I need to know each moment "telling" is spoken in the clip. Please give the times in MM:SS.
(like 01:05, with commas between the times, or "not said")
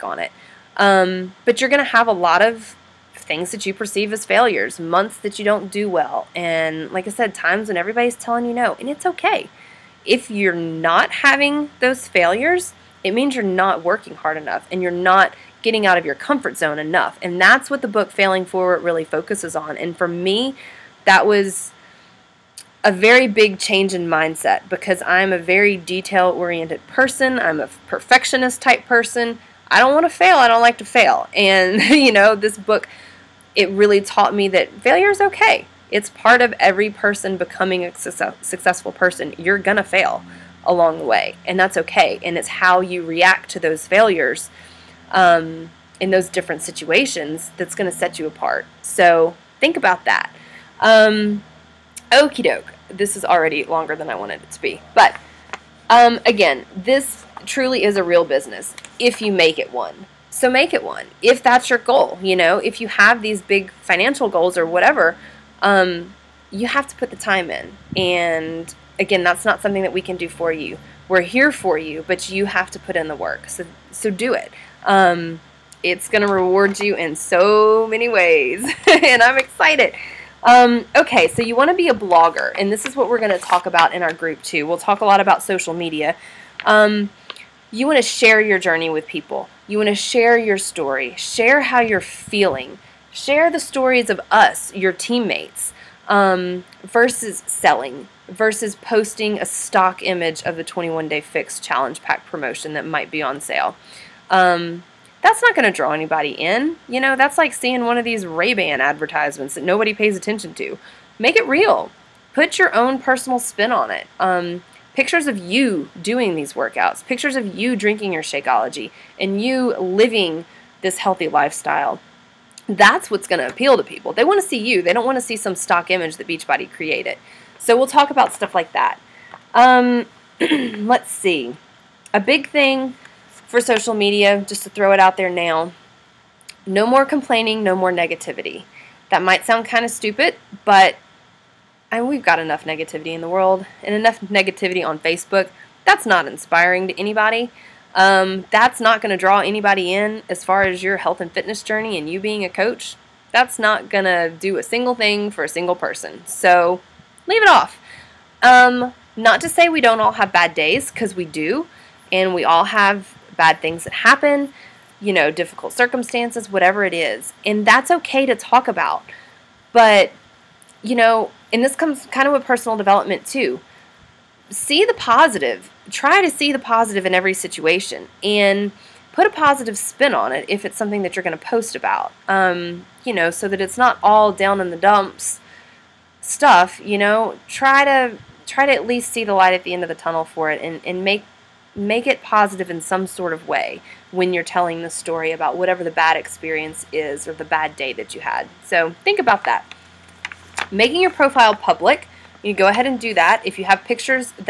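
00:08, 03:14.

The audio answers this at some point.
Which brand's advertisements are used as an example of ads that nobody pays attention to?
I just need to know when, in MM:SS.
01:48.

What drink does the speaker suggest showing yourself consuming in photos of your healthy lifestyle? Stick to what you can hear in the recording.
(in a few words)
Shakeology.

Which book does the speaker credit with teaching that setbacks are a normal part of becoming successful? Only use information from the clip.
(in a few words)
Failing Forward.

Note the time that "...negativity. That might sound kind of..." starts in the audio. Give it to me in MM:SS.
02:17.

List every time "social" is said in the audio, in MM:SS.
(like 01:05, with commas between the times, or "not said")
01:25, 02:13.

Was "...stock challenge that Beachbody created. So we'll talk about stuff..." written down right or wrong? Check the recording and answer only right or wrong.
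wrong.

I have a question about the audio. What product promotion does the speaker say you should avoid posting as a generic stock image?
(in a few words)
21 day fix challenge pack.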